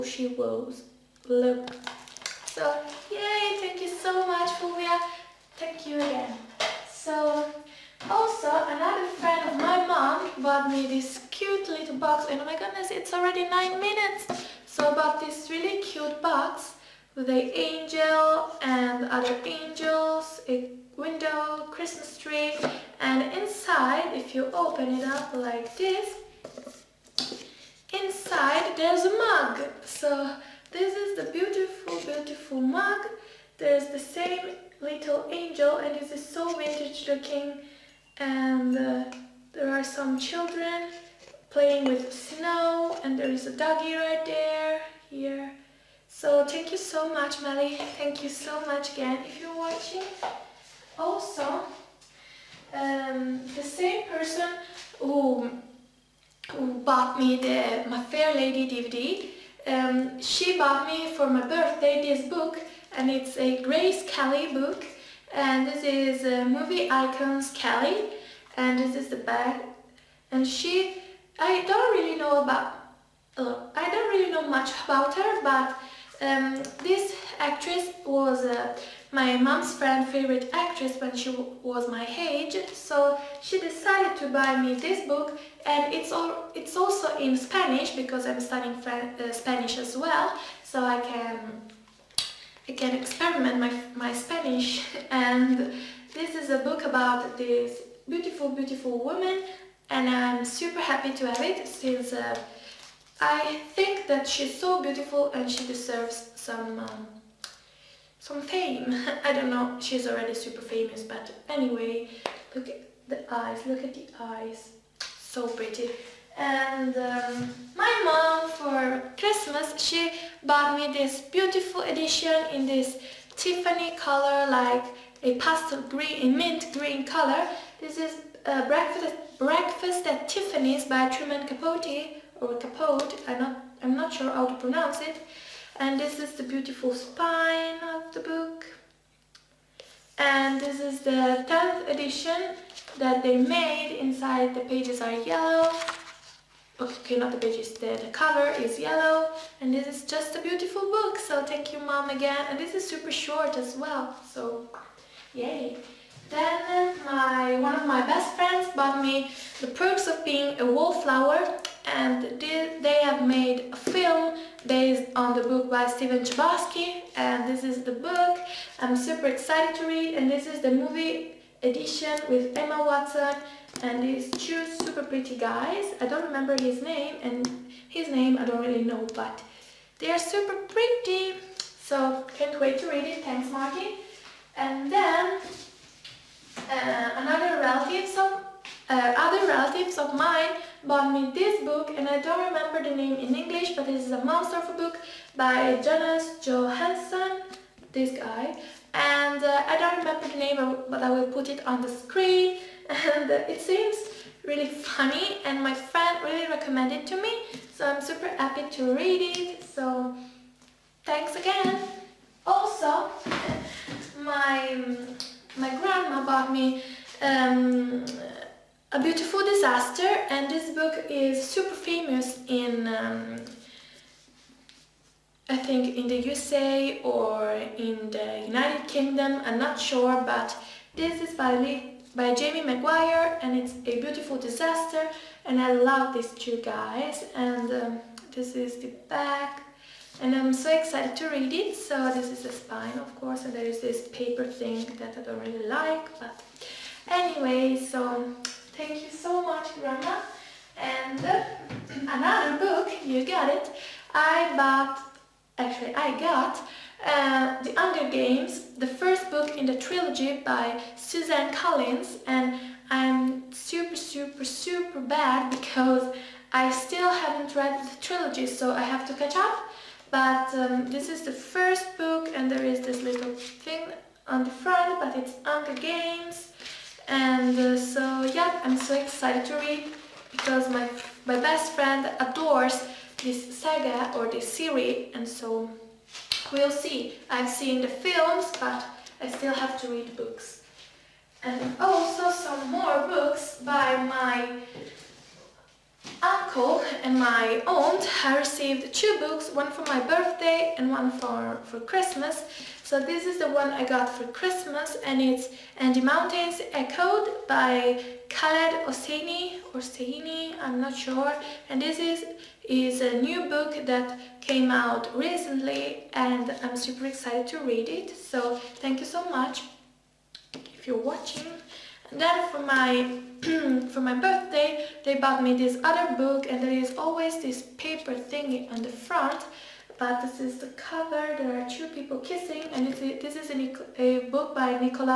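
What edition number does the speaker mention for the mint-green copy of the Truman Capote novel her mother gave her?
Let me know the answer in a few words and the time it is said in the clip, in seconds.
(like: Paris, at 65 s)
10th, at 141 s.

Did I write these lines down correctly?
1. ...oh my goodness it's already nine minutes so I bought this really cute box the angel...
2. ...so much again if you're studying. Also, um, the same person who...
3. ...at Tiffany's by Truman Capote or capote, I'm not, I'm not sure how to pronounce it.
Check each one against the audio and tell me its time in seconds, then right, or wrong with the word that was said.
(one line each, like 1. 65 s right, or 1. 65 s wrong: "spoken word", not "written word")
1. 12 s right
2. 48 s wrong: "watching", not "studying"
3. 130 s right.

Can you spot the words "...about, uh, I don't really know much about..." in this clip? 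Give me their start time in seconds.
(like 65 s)
72 s.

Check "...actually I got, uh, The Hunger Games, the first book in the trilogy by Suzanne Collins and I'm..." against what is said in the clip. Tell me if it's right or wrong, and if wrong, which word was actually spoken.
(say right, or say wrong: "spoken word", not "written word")
right.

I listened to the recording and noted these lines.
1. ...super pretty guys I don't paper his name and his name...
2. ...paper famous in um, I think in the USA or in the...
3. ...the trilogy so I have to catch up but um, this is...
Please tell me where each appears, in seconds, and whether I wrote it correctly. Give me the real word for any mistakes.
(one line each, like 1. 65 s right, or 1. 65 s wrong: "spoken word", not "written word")
1. 174 s wrong: "remember", not "paper"
2. 221 s wrong: "super", not "paper"
3. 267 s right.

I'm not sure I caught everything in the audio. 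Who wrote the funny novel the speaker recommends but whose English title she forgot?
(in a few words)
Jonas Jonasson.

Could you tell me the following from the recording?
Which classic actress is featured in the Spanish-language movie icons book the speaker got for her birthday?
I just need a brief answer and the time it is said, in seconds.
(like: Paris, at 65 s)
Grace Kelly, at 63 s.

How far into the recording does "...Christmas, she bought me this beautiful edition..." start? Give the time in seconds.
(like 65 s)
119 s.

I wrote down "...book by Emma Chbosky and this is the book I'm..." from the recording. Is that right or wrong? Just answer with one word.
wrong.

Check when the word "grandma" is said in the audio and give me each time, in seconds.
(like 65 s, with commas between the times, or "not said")
215 s, 249 s.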